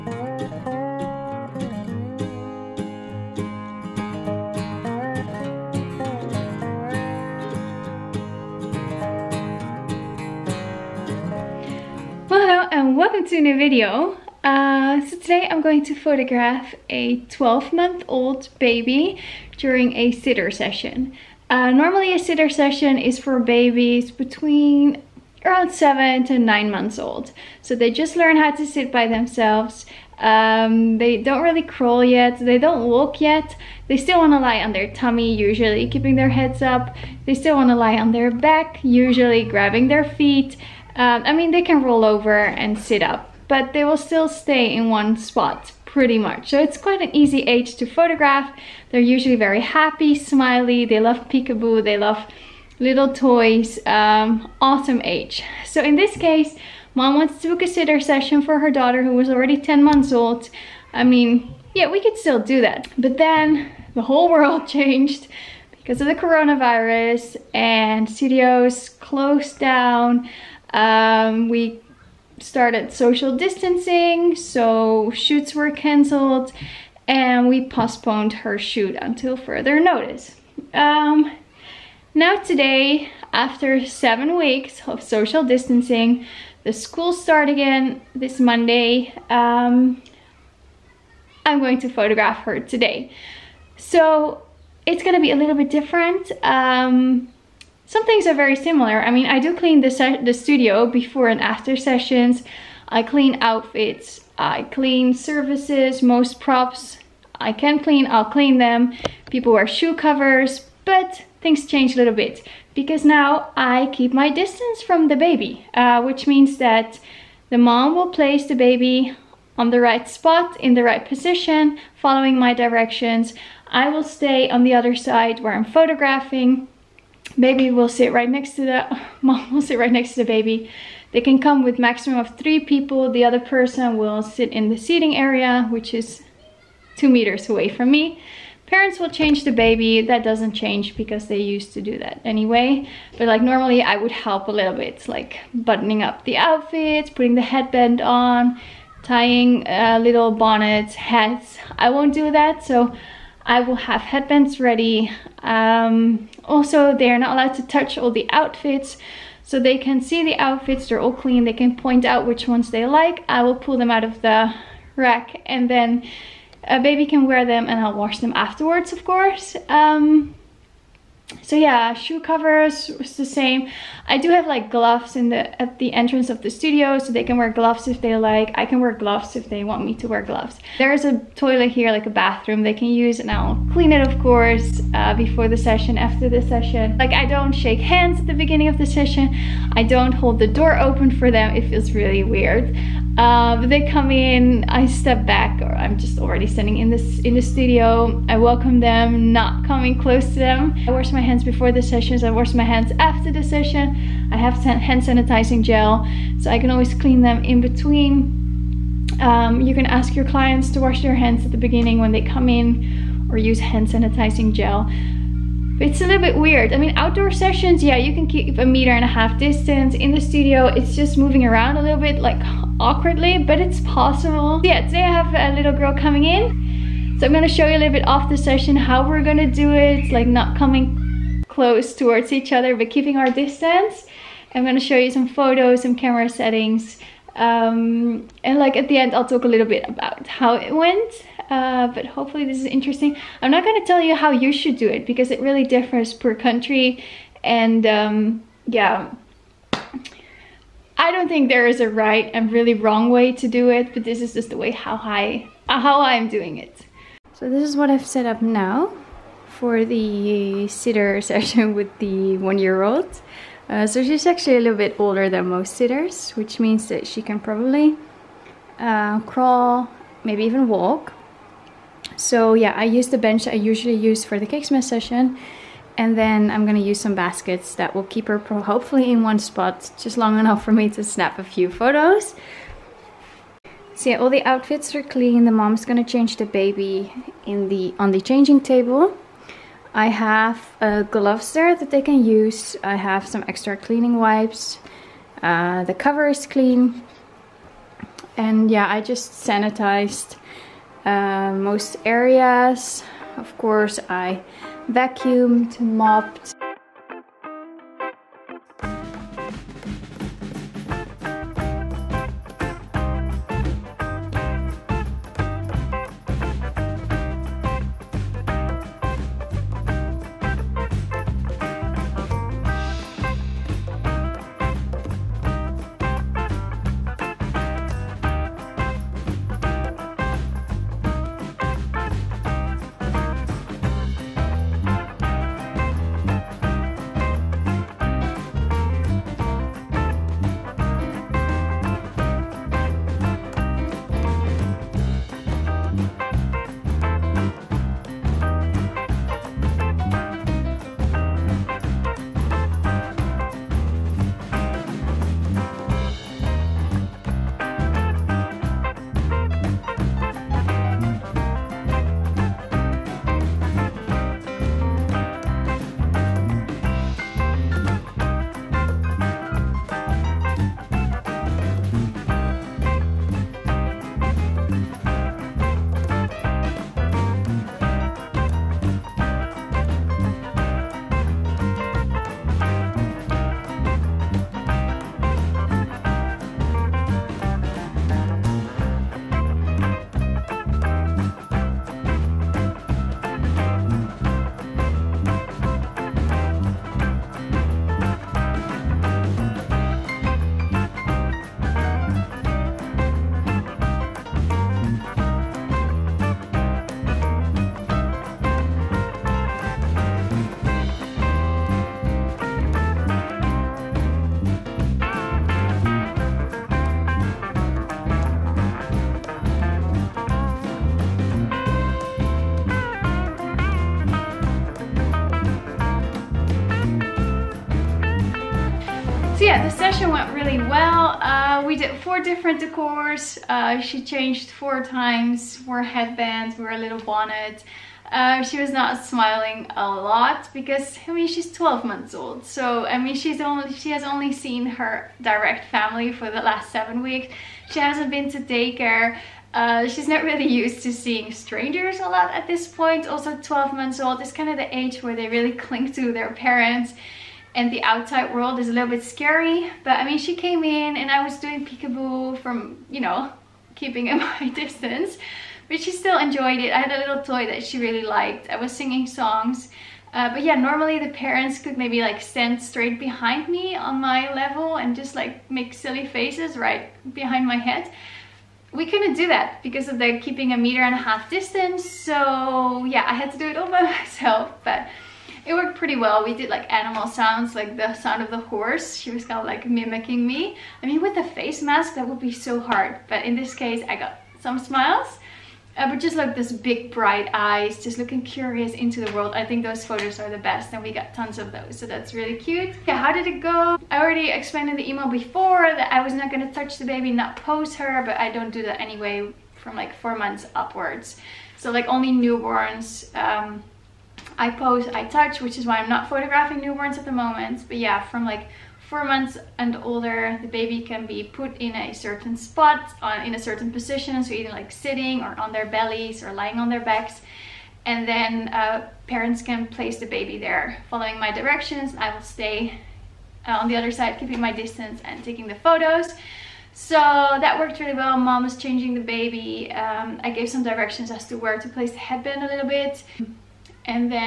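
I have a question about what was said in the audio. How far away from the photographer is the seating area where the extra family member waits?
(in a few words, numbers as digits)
2 meters.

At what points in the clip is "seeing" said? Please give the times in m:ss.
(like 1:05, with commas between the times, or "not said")
7:30.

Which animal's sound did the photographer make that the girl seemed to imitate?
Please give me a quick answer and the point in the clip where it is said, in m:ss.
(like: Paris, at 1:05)
Horse, at 8:08.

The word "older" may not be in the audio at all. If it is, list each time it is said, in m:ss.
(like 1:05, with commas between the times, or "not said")
4:24, 8:39.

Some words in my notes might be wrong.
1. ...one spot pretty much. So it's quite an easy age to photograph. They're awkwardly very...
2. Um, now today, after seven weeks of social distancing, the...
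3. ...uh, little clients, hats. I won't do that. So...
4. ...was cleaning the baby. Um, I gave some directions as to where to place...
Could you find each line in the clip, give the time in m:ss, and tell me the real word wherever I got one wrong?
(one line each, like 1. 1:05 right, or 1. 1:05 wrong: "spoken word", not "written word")
1. 0:44 wrong: "usually", not "awkwardly"
2. 1:20 right
3. 2:29 wrong: "bonnets", not "clients"
4. 8:58 wrong: "changing", not "cleaning".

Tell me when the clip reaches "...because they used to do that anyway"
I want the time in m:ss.
2:20.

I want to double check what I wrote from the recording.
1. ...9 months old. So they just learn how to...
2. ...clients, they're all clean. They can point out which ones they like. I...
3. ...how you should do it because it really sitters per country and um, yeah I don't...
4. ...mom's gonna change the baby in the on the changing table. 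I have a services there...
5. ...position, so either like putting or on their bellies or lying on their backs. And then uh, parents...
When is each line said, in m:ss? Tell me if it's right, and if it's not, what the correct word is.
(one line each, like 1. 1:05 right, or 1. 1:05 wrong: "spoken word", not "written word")
1. 0:26 right
2. 2:40 wrong: "outfits", not "clients"
3. 4:04 wrong: "differs", not "sitters"
4. 4:45 wrong: "gloves", not "services"
5. 8:43 wrong: "sitting", not "putting".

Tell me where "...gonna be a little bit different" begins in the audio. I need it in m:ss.
1:35.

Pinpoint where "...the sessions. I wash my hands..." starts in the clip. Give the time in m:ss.
3:21.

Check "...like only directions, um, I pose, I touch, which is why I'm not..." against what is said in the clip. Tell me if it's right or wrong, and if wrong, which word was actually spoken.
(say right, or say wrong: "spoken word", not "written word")
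wrong: "newborns", not "directions".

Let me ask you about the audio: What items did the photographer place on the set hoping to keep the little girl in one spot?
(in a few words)
Baskets.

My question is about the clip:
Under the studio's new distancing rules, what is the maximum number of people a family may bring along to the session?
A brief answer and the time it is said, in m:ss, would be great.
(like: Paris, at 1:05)
3, at 2:12.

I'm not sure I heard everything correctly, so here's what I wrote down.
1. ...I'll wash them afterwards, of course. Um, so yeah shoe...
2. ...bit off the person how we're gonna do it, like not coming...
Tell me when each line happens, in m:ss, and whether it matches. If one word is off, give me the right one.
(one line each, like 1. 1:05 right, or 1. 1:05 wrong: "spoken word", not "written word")
1. 2:47 right
2. 3:47 wrong: "session", not "person".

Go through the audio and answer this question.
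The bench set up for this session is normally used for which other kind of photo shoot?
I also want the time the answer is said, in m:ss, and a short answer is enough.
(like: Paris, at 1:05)
Cake smash session, at 4:34.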